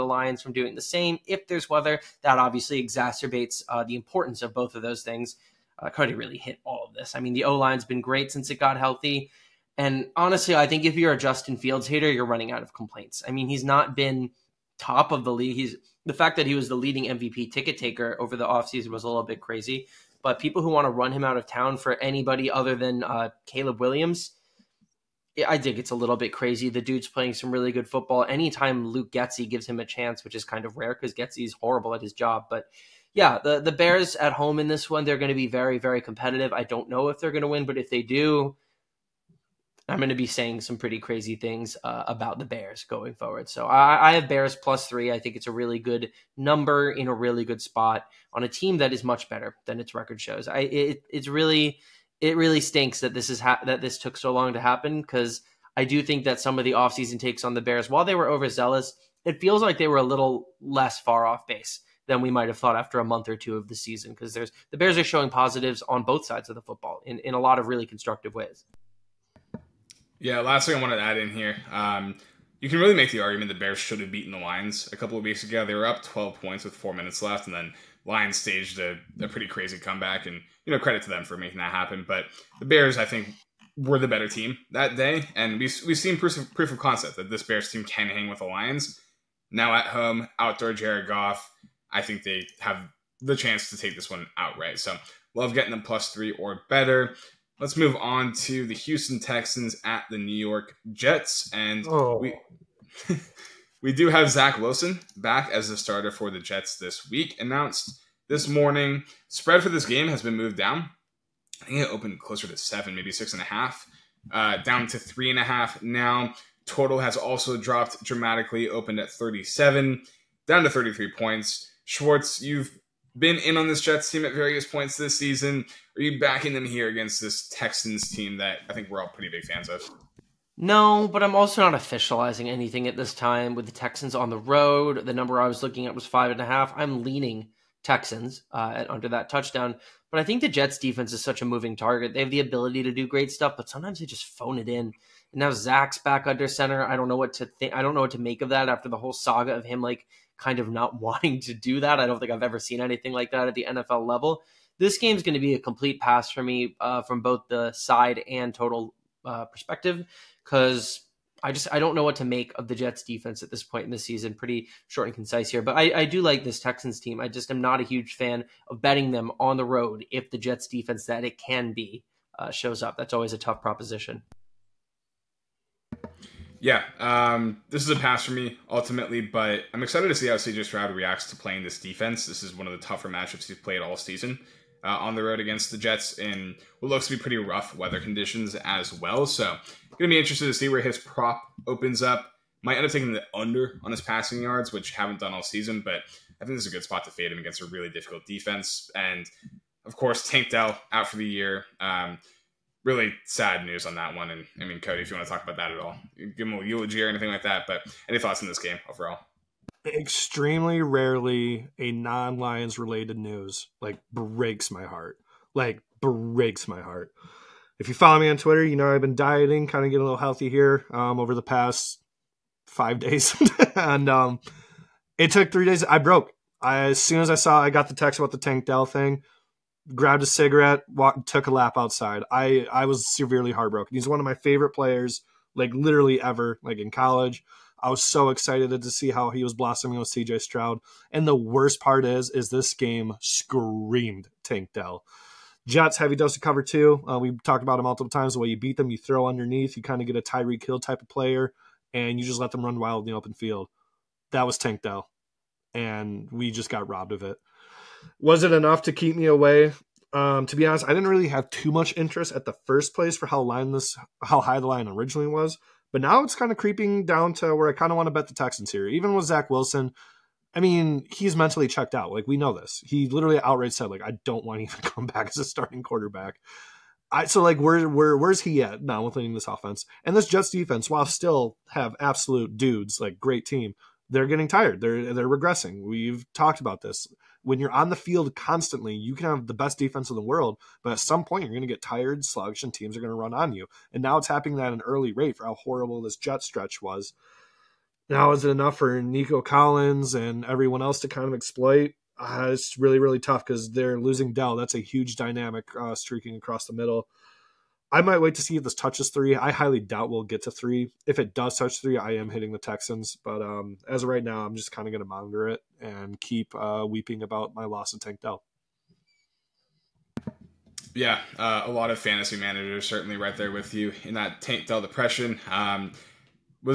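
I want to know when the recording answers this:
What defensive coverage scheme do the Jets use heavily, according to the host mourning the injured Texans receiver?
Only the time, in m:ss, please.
4:06.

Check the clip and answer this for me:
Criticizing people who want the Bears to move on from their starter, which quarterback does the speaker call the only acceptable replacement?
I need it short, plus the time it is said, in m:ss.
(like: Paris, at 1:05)
Caleb Williams, at 0:23.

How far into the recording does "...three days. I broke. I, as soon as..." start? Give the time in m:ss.
3:45.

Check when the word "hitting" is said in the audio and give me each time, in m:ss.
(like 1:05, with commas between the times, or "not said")
5:12.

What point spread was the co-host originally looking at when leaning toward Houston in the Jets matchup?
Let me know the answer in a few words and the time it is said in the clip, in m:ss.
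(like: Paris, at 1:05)
5.5, at 2:16.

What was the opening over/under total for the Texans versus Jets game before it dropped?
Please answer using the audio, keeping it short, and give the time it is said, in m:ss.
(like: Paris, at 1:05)
37, at 1:59.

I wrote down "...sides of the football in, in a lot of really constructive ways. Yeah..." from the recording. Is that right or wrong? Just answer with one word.
right.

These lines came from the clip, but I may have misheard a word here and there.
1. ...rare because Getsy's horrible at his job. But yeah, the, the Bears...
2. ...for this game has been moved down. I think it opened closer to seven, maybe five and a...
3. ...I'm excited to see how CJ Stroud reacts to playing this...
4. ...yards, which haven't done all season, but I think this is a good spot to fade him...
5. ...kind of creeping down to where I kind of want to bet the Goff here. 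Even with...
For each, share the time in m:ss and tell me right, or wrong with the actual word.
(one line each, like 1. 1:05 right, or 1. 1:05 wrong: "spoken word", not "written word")
1. 0:30 right
2. 1:49 wrong: "six", not "five"
3. 2:59 right
4. 3:14 right
5. 4:26 wrong: "Texans", not "Goff".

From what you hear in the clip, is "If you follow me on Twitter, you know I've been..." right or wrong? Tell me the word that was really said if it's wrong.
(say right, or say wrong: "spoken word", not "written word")
right.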